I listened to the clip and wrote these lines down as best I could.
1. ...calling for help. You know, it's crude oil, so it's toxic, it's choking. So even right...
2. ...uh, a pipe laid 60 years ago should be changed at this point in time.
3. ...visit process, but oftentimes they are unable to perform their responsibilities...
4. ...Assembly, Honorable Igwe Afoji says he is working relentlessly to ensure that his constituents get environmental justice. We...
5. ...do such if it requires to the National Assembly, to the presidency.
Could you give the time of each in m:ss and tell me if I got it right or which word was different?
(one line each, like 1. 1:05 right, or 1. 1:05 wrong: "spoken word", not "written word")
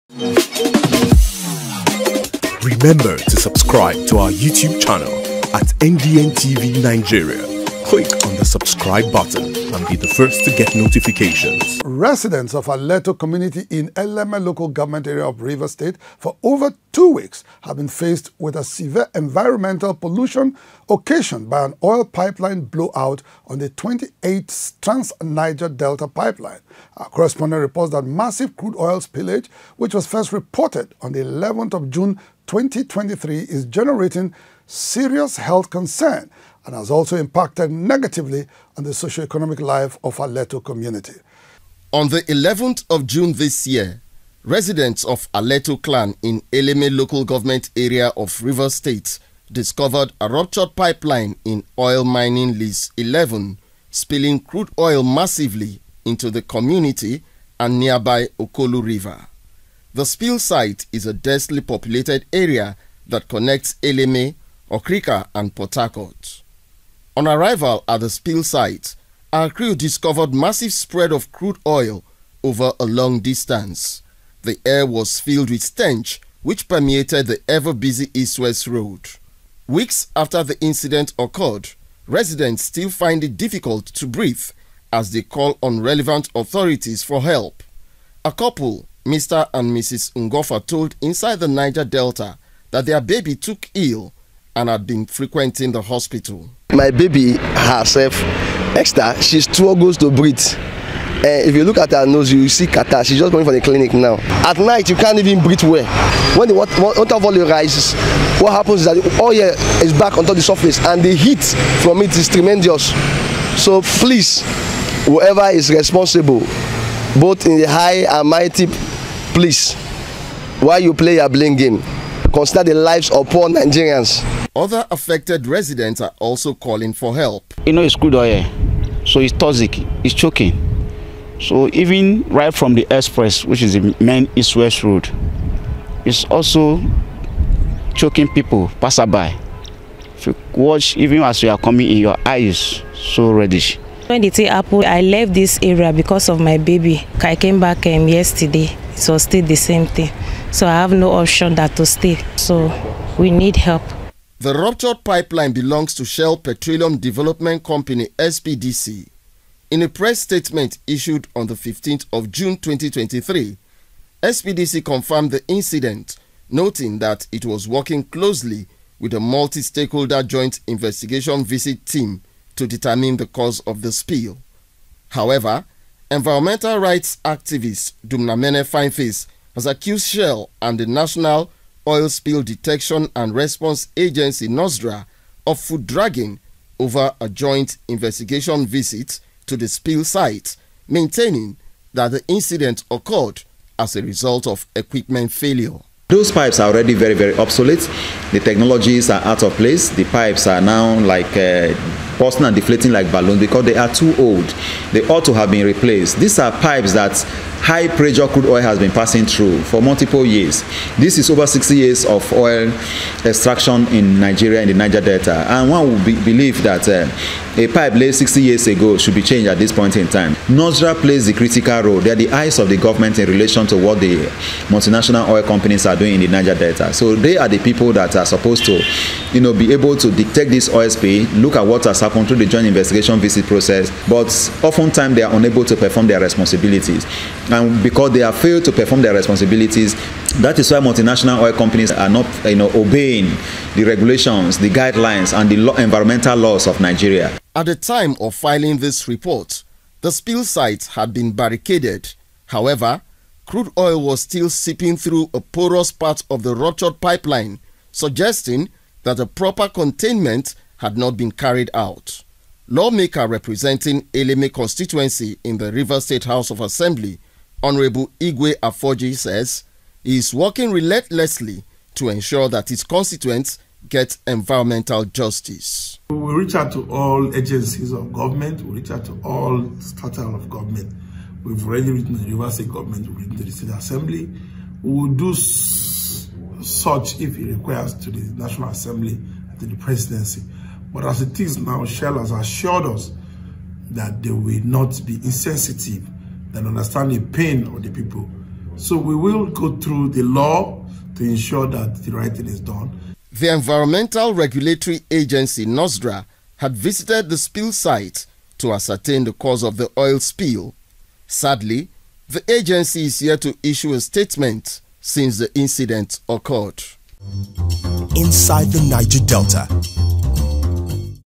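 1. 2:06 right
2. 3:36 right
3. 3:53 right
4. 4:26 right
5. 4:45 right.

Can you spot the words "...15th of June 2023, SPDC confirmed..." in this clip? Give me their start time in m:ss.
2:41.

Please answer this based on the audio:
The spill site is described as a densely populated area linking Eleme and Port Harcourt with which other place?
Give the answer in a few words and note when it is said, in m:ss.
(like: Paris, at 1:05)
Okrika, at 1:04.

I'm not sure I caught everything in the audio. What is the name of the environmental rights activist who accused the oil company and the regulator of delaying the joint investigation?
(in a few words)
Dumnamene Fineface.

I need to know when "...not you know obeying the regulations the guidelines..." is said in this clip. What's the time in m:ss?
4:02.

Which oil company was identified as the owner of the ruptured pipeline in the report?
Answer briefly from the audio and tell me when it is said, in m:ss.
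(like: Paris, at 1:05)
Shell Petroleum Development Company, at 2:36.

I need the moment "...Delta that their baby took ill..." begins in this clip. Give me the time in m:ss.
1:31.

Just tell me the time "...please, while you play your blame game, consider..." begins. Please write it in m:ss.
1:59.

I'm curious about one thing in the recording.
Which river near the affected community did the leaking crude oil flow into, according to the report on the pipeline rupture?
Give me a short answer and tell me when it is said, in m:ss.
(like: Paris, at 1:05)
Okolu River, at 0:58.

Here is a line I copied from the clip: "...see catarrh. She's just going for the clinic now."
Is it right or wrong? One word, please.
right.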